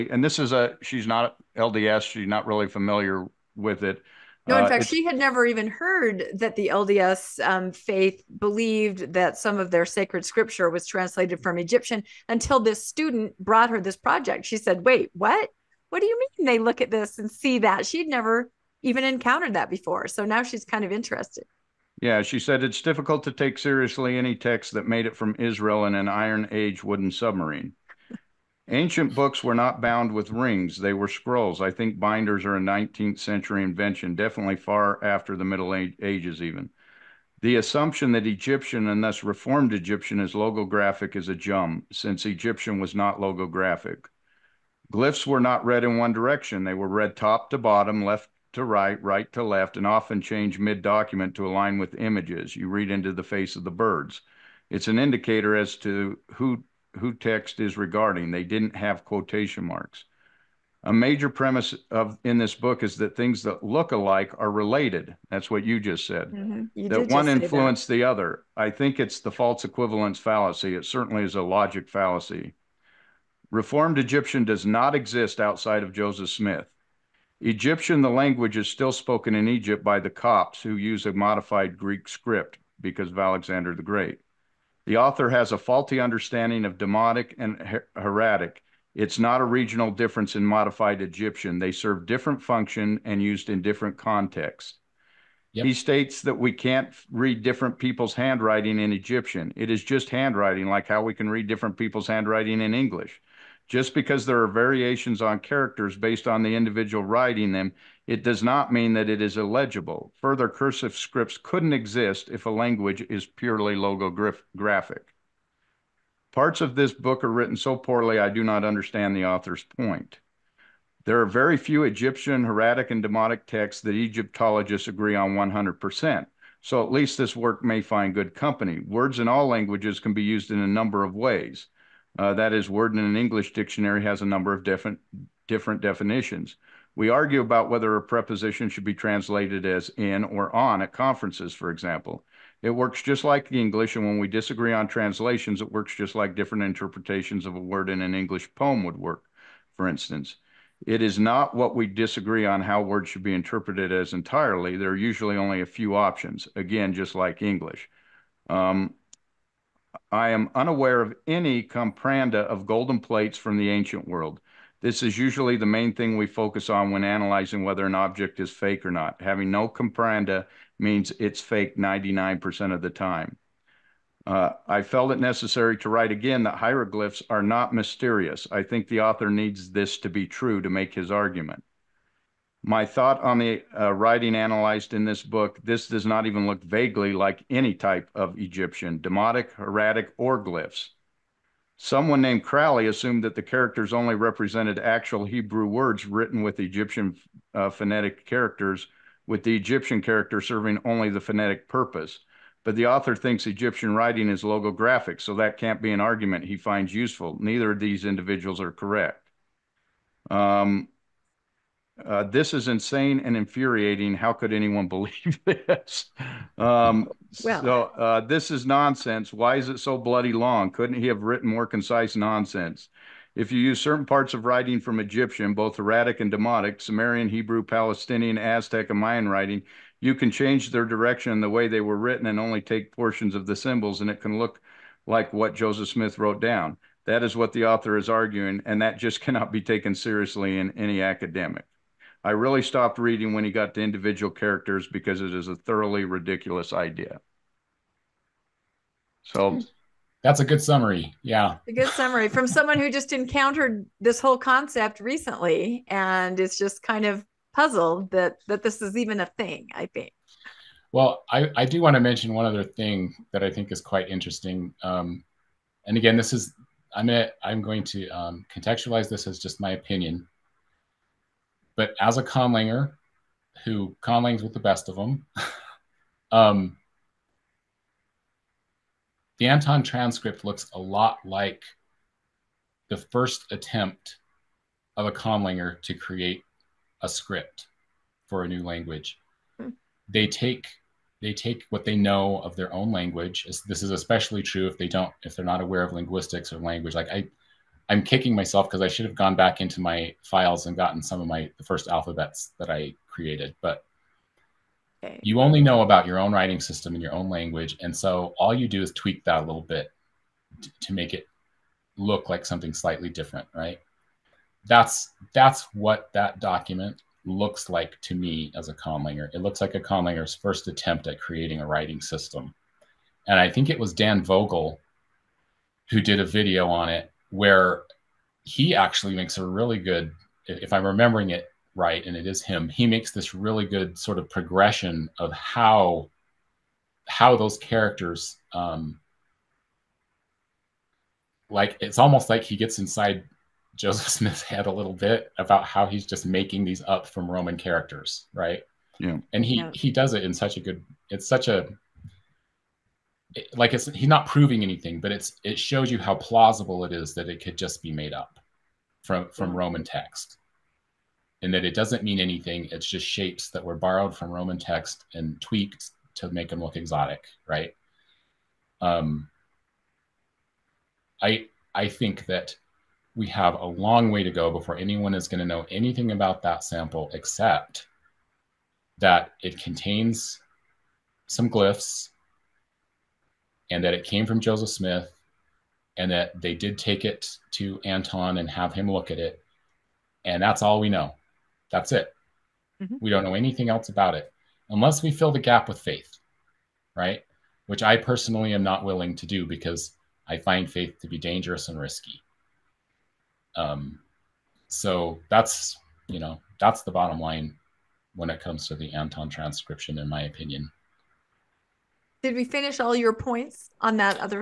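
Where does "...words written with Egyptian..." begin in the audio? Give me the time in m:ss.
3:15.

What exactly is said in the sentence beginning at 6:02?
It's just shapes that were borrowed from Roman text and tweaked to make them look exotic, right?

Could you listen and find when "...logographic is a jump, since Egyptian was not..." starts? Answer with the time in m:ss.
0:40.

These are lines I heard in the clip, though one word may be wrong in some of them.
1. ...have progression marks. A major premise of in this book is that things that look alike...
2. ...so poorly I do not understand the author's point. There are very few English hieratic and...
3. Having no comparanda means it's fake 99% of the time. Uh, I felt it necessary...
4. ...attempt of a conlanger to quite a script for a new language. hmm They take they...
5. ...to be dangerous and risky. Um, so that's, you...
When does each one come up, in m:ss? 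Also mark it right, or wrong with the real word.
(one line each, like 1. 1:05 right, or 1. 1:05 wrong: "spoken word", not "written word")
1. 0:58 wrong: "quotation", not "progression"
2. 1:57 wrong: "Egyptian", not "English"
3. 2:49 right
4. 4:43 wrong: "create", not "quite"
5. 6:40 right.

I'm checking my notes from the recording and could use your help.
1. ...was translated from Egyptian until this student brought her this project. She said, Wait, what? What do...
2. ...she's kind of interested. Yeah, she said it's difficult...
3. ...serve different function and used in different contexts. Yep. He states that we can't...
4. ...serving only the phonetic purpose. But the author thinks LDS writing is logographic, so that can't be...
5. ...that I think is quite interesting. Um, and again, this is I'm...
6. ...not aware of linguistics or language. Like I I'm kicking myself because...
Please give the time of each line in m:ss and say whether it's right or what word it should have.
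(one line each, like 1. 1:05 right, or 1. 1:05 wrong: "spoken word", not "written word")
1. 0:10 right
2. 0:20 right
3. 1:31 right
4. 3:20 wrong: "Egyptian", not "LDS"
5. 4:23 right
6. 4:55 right.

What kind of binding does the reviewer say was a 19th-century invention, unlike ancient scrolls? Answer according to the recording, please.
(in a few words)
Binders.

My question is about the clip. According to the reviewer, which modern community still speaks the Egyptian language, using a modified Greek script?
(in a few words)
The Copts.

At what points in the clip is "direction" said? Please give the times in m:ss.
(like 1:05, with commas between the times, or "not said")
0:46, 3:50.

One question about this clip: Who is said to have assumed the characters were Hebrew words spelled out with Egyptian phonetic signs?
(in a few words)
Crowley.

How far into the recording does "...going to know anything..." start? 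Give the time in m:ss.
6:15.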